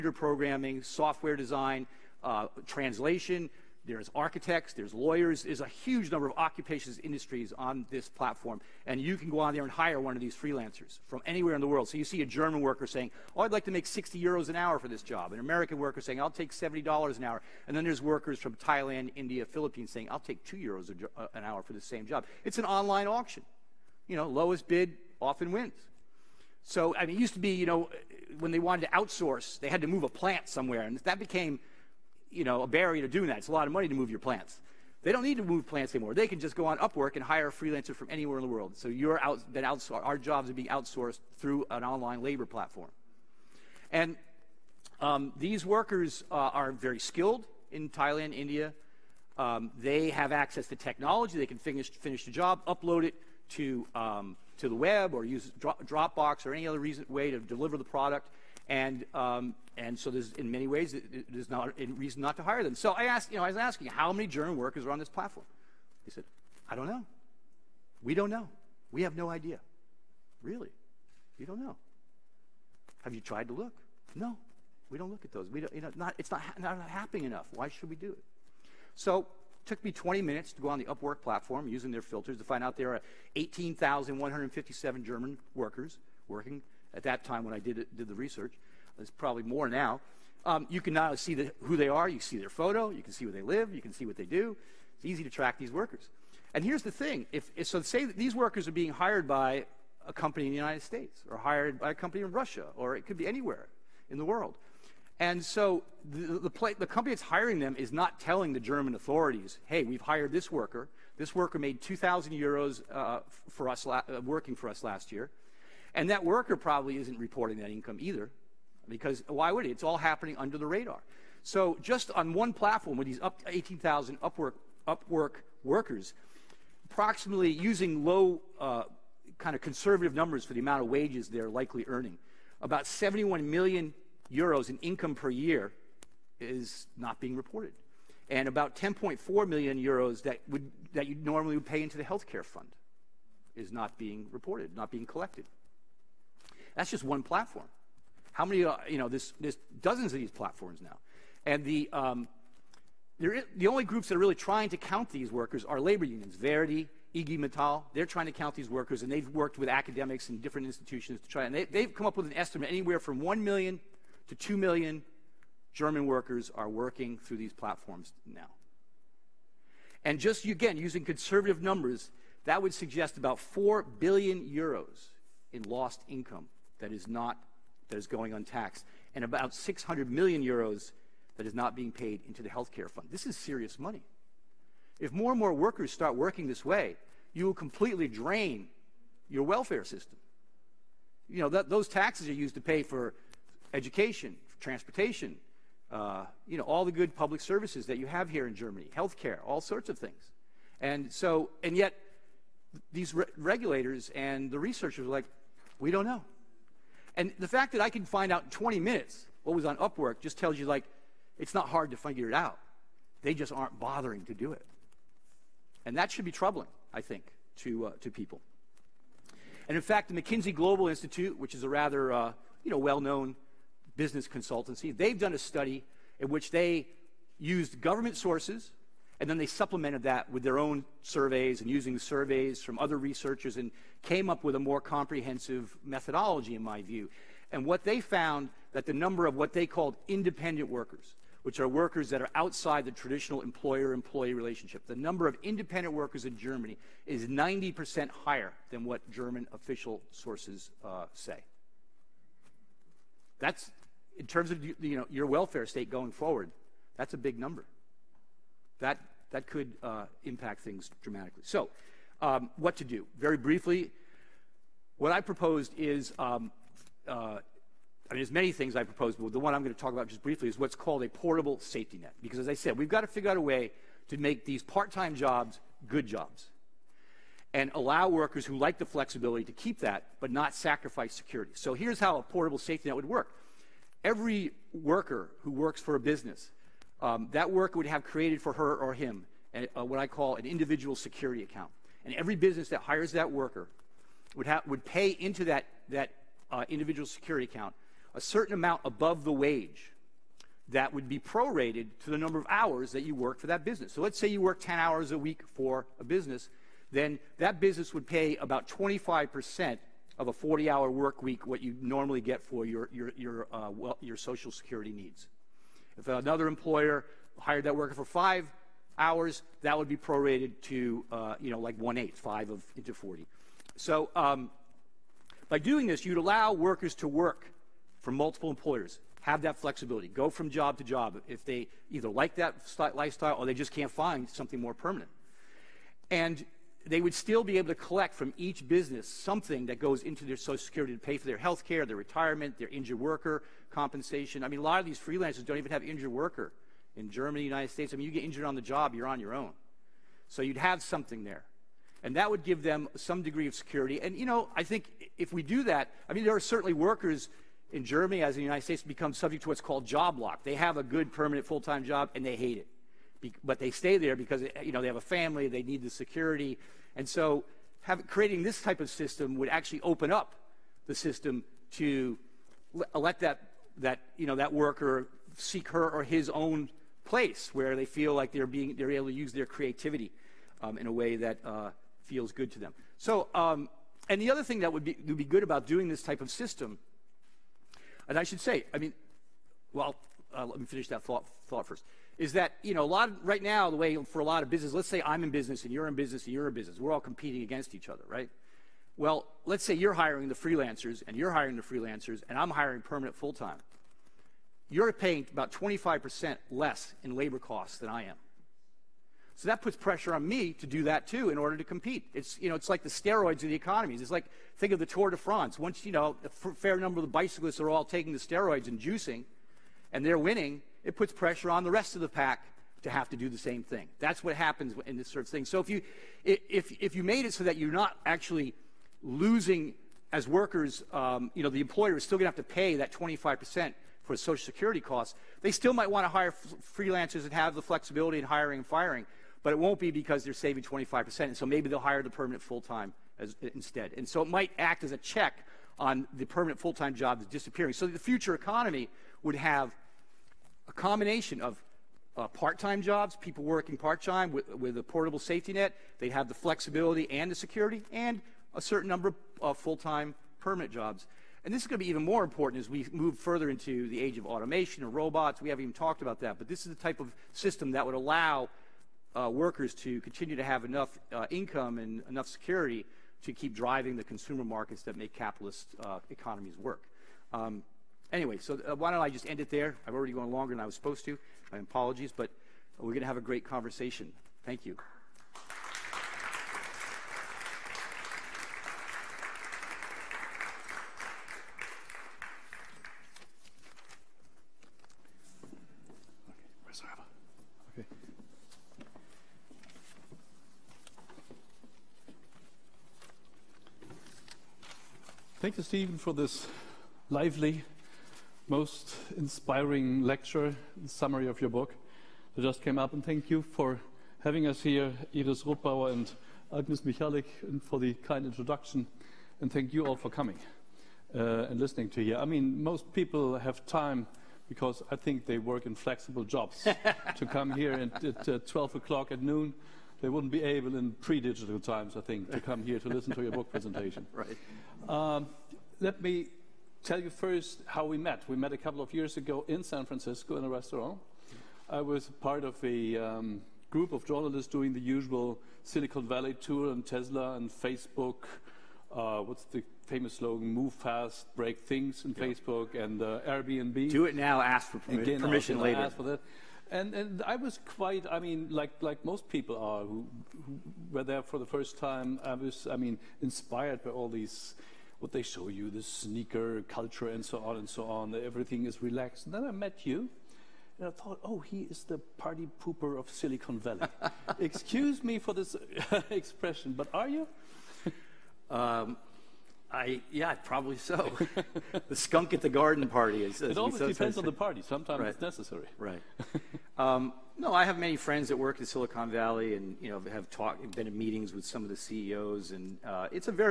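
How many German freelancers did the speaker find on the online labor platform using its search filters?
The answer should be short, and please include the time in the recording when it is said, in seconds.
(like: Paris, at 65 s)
18,157, at 83 s.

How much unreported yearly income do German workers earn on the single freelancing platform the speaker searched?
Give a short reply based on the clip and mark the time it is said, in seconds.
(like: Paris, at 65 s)
71 million euros, at 132 s.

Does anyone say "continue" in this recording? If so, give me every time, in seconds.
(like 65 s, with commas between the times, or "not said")
470 s.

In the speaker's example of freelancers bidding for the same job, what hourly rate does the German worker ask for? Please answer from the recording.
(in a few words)
60 euros.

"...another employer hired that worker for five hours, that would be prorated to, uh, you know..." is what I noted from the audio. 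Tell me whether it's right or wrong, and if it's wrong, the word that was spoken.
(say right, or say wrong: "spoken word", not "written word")
right.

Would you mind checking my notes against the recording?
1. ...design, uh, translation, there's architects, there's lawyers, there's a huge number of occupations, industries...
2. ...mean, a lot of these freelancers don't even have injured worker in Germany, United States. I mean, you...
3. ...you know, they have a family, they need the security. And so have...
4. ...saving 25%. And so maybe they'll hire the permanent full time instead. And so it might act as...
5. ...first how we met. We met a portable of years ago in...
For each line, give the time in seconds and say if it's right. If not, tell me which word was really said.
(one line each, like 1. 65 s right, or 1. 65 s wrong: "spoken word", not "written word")
1. 1 s right
2. 344 s right
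3. 364 s right
4. 440 s right
5. 537 s wrong: "couple", not "portable".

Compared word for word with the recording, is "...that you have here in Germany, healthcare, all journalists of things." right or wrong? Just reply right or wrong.
wrong.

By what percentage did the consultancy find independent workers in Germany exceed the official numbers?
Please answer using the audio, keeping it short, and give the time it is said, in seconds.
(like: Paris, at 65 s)
90%, at 247 s.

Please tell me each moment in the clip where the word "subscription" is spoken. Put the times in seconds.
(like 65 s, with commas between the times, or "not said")
not said.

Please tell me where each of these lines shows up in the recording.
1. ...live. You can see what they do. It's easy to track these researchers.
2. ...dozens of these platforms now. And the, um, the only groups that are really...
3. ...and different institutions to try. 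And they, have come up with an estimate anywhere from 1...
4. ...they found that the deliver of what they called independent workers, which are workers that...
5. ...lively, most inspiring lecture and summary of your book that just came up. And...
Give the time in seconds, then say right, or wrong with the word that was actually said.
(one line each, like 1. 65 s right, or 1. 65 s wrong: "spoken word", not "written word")
1. 93 s wrong: "workers", not "researchers"
2. 149 s right
3. 160 s right
4. 237 s wrong: "number", not "deliver"
5. 507 s right.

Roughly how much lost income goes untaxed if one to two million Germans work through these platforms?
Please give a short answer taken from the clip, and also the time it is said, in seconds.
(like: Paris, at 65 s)
4 billion euros, at 173 s.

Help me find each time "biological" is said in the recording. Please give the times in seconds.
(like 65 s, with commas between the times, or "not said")
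not said.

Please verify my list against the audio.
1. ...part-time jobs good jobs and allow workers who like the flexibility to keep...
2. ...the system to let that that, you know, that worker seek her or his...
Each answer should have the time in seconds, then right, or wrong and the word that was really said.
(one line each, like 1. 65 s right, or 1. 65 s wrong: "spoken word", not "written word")
1. 274 s right
2. 370 s right.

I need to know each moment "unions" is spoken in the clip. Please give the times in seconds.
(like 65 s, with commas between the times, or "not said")
156 s.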